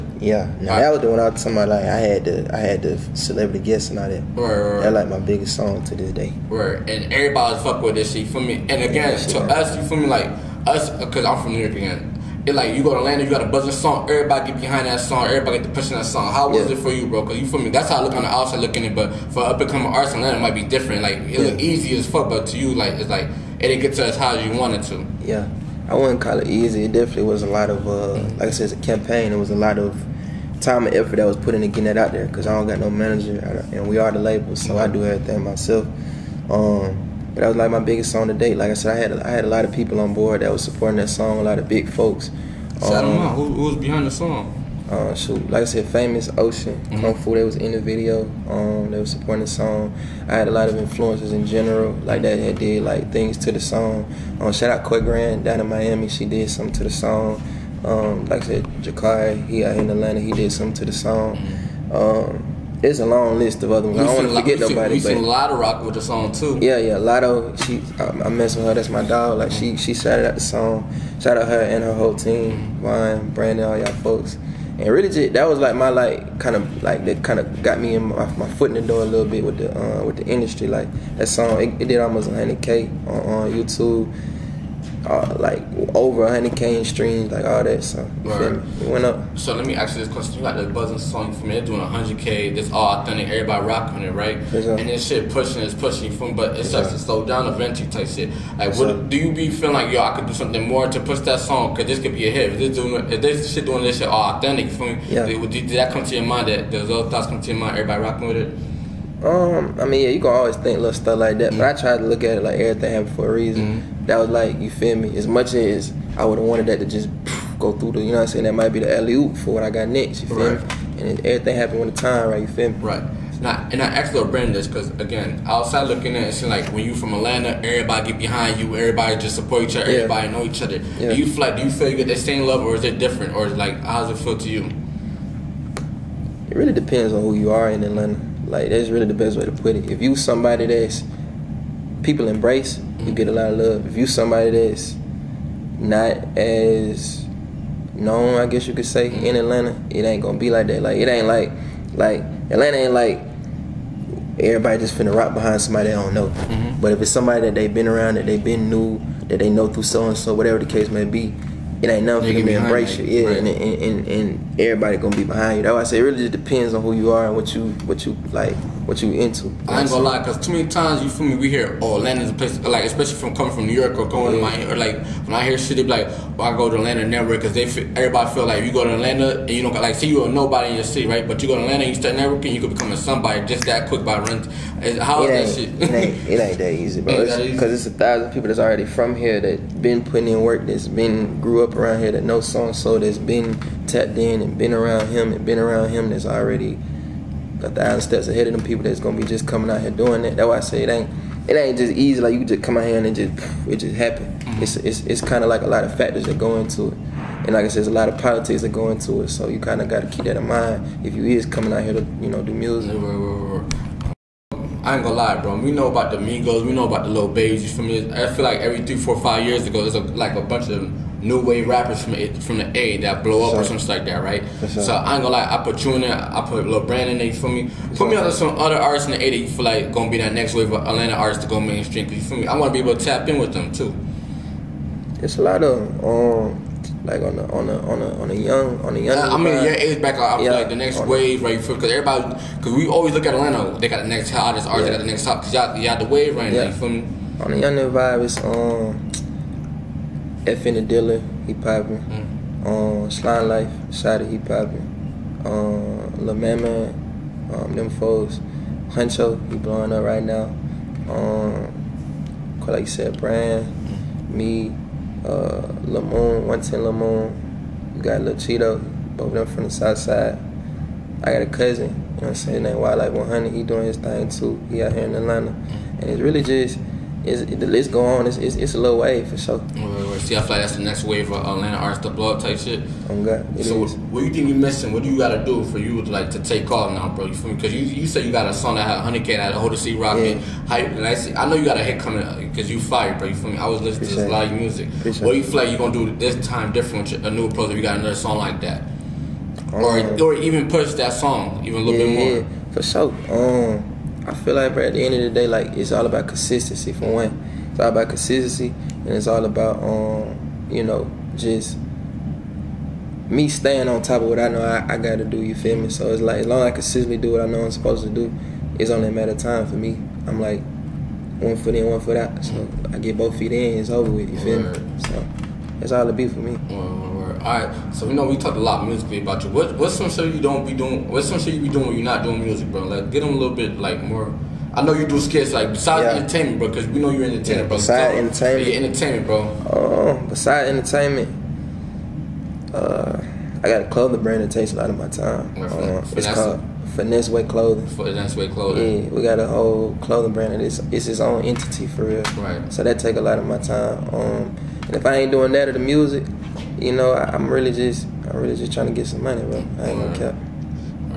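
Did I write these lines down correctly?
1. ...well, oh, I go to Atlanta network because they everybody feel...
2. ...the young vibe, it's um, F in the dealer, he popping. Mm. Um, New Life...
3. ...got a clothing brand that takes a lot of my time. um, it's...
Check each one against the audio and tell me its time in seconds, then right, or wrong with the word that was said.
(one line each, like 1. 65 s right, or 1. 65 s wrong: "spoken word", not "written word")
1. 176 s right
2. 247 s wrong: "Slime", not "New"
3. 343 s right.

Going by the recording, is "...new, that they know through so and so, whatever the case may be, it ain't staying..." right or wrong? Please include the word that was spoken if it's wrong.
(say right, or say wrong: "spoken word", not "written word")
wrong: "nothing", not "staying".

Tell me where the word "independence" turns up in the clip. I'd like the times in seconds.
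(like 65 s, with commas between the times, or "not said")
not said.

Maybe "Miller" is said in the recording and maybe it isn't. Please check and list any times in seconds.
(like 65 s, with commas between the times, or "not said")
not said.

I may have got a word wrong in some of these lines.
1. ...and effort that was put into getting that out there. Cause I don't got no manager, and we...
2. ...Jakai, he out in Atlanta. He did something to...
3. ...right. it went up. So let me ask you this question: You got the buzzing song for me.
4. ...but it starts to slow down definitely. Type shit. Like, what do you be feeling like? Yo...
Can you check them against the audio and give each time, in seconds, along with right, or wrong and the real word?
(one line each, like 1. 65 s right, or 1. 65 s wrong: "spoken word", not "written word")
1. 30 s right
2. 58 s right
3. 88 s right
4. 96 s wrong: "eventually", not "definitely".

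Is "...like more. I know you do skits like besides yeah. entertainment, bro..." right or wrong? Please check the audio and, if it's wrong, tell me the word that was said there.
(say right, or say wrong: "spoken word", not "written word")
right.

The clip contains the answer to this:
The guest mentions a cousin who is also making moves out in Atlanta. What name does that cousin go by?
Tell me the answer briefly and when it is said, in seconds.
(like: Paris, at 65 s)
Wildlife 100, at 272 s.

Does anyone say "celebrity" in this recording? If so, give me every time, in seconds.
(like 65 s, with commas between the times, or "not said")
3 s.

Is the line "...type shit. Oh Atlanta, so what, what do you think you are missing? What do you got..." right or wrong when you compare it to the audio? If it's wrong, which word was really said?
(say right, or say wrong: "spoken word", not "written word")
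wrong: "God", not "Atlanta".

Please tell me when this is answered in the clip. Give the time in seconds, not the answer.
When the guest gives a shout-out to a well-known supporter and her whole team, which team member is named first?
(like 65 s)
72 s.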